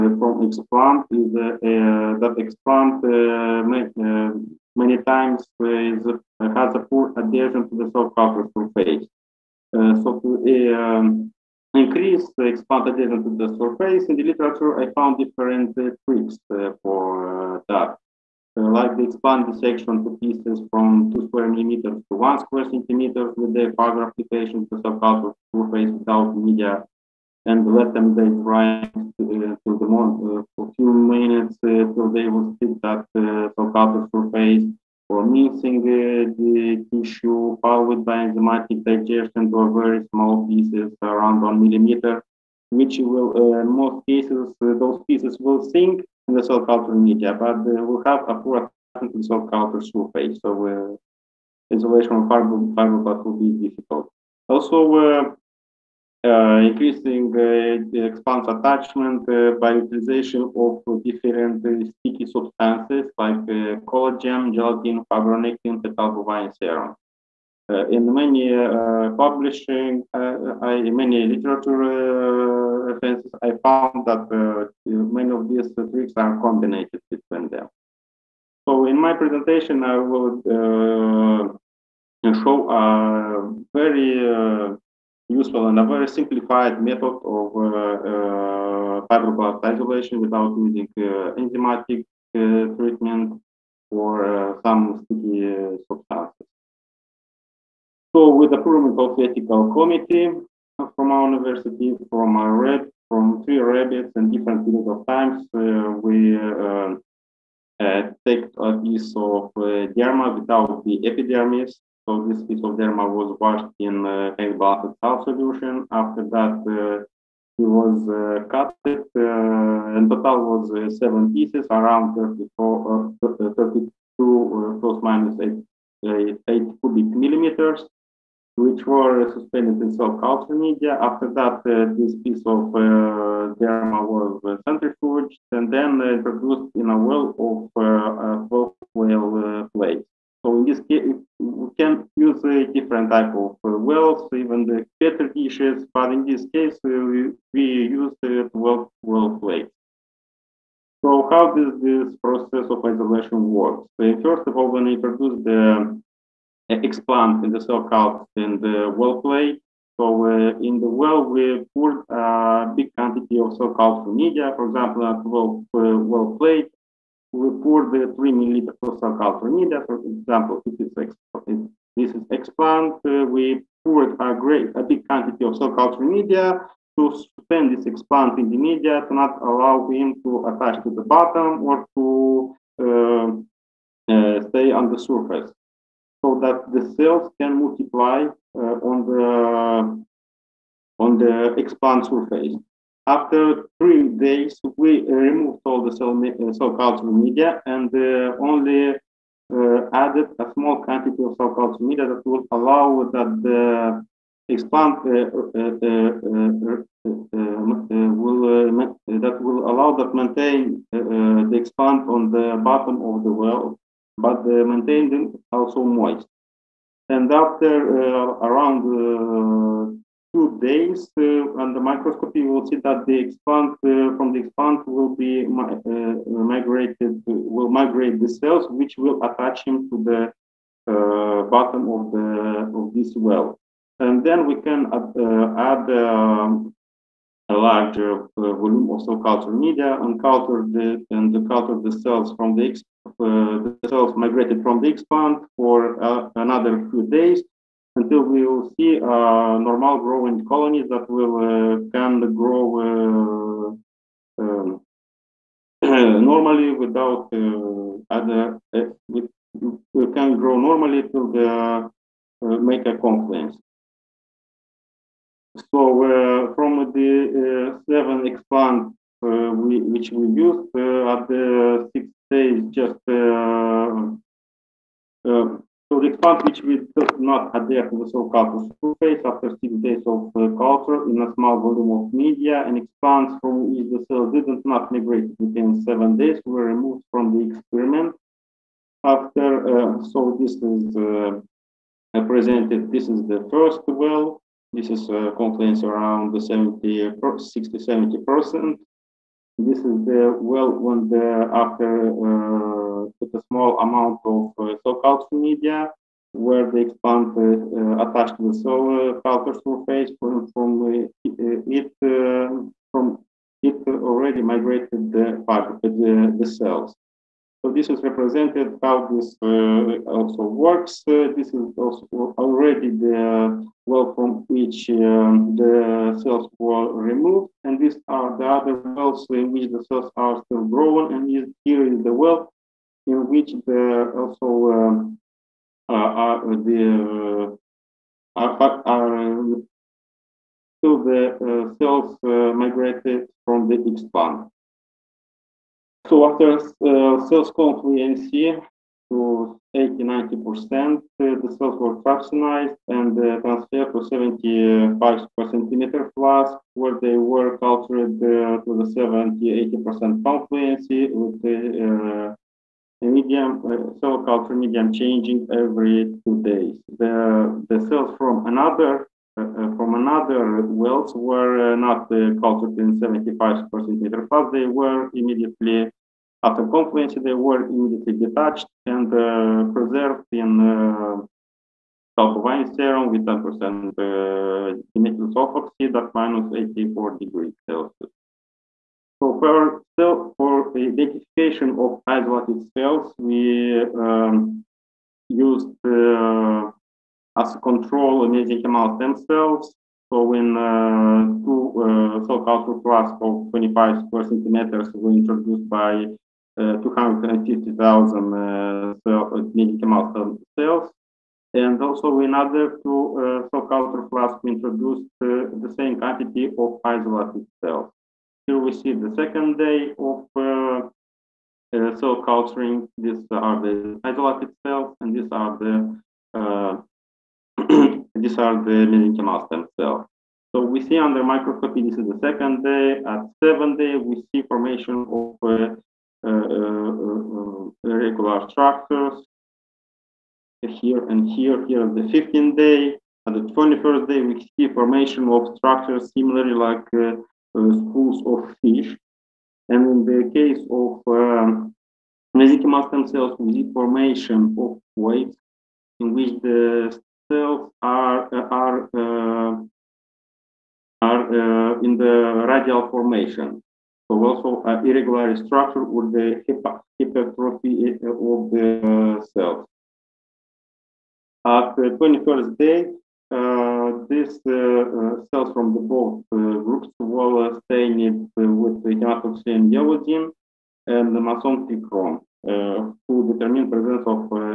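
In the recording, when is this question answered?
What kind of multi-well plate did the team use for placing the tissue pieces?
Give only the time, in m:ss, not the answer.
2:28.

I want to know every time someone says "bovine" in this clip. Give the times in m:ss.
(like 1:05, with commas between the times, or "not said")
1:06, 6:22.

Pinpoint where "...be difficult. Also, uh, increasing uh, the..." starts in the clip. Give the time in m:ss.
0:53.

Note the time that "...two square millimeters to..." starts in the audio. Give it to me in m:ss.
0:21.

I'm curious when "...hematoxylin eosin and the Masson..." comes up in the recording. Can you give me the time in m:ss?
7:58.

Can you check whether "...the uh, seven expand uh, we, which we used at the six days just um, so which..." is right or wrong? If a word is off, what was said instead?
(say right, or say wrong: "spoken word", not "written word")
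right.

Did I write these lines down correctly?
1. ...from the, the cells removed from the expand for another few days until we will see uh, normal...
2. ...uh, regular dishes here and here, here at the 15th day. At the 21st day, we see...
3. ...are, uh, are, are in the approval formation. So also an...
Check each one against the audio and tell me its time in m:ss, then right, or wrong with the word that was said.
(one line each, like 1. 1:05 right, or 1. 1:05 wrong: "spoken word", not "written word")
1. 4:02 wrong: "migrated", not "removed"
2. 7:17 wrong: "structures", not "dishes"
3. 7:37 wrong: "radial", not "approval".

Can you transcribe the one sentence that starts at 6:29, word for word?
So for, cell, for identification of isolated cells, we um, used uh, as a control mesenchymal stem cells.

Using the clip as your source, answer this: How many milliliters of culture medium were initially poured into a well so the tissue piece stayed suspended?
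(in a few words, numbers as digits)
3.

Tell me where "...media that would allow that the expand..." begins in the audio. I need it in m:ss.
3:21.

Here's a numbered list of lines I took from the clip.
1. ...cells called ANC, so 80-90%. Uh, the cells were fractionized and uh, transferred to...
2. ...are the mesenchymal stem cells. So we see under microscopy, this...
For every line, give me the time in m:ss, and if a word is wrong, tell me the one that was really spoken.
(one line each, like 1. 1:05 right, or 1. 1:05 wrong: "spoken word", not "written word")
1. 5:47 right
2. 7:08 right.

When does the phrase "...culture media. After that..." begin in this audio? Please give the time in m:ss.
2:10.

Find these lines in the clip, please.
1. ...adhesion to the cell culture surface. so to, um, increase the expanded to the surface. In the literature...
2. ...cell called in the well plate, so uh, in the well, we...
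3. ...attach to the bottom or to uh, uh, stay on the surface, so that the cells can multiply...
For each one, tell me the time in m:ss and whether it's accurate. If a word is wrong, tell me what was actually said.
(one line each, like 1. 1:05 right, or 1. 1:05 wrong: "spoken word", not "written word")
1. 0:07 right
2. 2:37 right
3. 3:00 right.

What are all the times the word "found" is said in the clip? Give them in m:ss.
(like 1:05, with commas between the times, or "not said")
0:14, 1:13.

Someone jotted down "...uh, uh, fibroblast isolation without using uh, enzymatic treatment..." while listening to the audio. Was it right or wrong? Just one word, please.
right.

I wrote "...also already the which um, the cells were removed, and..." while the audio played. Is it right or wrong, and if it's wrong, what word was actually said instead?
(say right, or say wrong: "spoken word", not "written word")
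right.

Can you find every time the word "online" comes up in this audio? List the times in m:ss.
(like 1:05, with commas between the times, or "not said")
not said.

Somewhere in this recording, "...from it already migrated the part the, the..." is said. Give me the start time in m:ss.
5:12.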